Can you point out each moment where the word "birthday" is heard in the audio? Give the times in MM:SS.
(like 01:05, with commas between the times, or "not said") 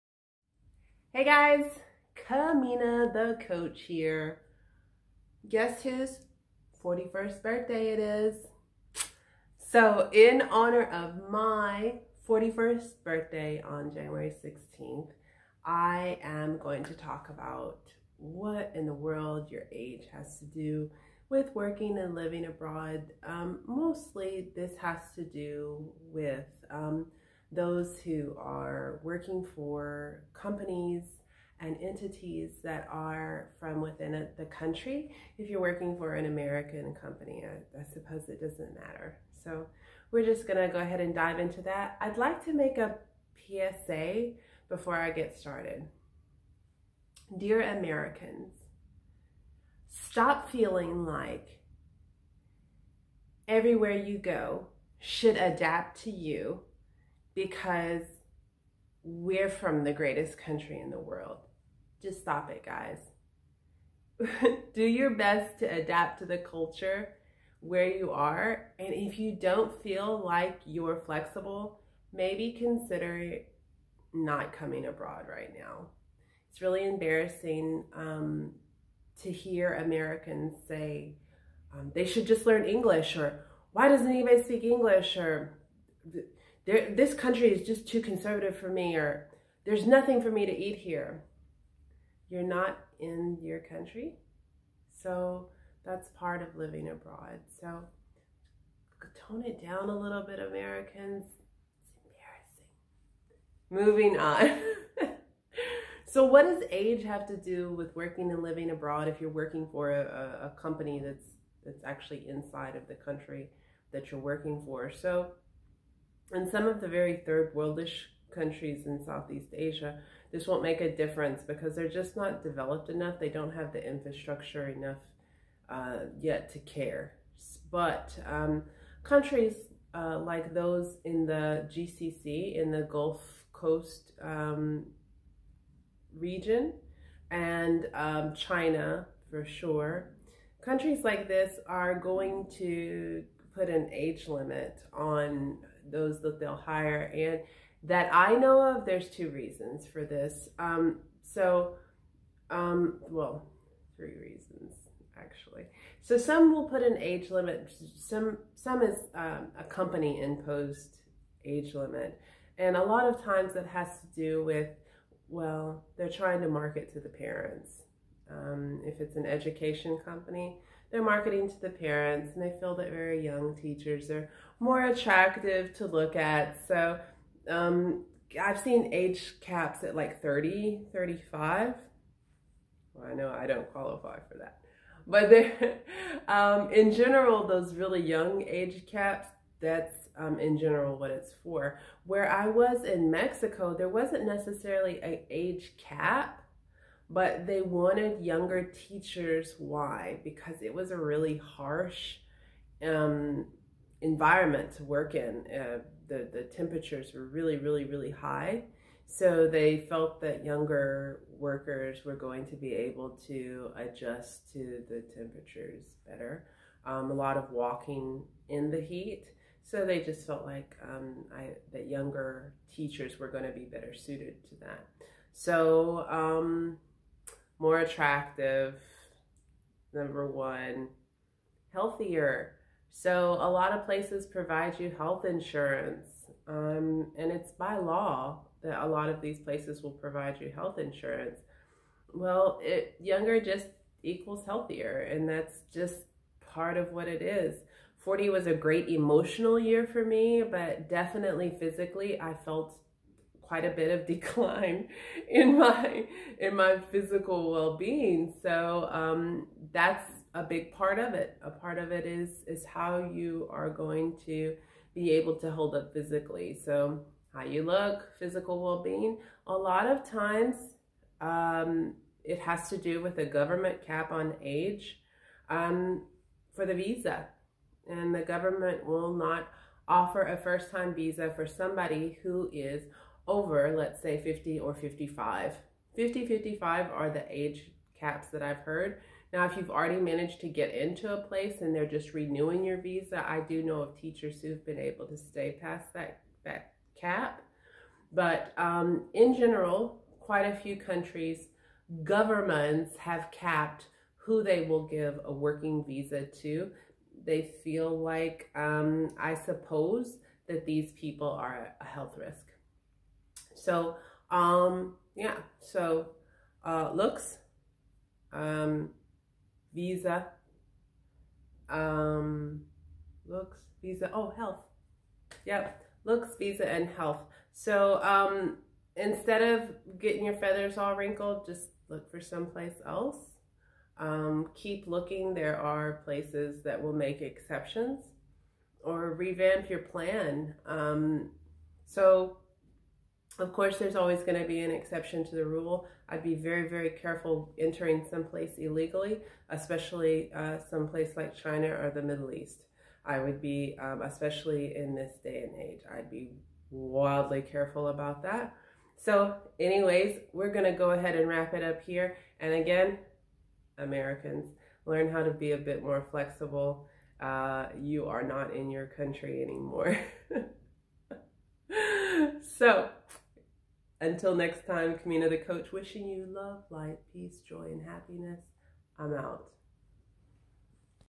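00:07, 00:13.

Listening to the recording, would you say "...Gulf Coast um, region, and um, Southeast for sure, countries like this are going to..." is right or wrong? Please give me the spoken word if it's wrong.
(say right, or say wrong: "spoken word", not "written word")
wrong: "China", not "Southeast".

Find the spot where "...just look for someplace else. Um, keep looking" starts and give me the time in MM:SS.
05:31.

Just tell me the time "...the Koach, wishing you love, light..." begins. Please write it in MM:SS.
06:15.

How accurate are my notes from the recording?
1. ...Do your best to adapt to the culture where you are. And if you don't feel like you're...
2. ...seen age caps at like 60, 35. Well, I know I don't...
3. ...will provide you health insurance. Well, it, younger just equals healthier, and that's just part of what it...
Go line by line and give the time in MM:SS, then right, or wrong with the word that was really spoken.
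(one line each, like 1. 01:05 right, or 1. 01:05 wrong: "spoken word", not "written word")
1. 01:04 right
2. 02:58 wrong: "30", not "60"
3. 03:59 right.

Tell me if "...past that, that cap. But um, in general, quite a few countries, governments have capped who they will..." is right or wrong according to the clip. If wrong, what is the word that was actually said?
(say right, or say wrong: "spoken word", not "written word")
right.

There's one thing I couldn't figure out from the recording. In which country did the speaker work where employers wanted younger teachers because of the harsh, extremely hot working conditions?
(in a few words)
Mexico.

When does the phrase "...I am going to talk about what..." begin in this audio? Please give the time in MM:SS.
00:15.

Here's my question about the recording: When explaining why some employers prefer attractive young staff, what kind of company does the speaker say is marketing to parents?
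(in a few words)
Education company.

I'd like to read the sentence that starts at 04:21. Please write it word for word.
A part of it is is how you are going to be able to hold up physically.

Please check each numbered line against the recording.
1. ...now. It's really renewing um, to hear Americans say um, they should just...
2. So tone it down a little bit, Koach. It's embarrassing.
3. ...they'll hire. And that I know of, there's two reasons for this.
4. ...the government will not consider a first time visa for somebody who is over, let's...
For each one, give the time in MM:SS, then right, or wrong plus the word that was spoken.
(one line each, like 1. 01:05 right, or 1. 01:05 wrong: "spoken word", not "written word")
1. 01:15 wrong: "embarrassing", not "renewing"
2. 01:37 wrong: "Americans", not "Koach"
3. 02:26 right
4. 04:38 wrong: "offer", not "consider".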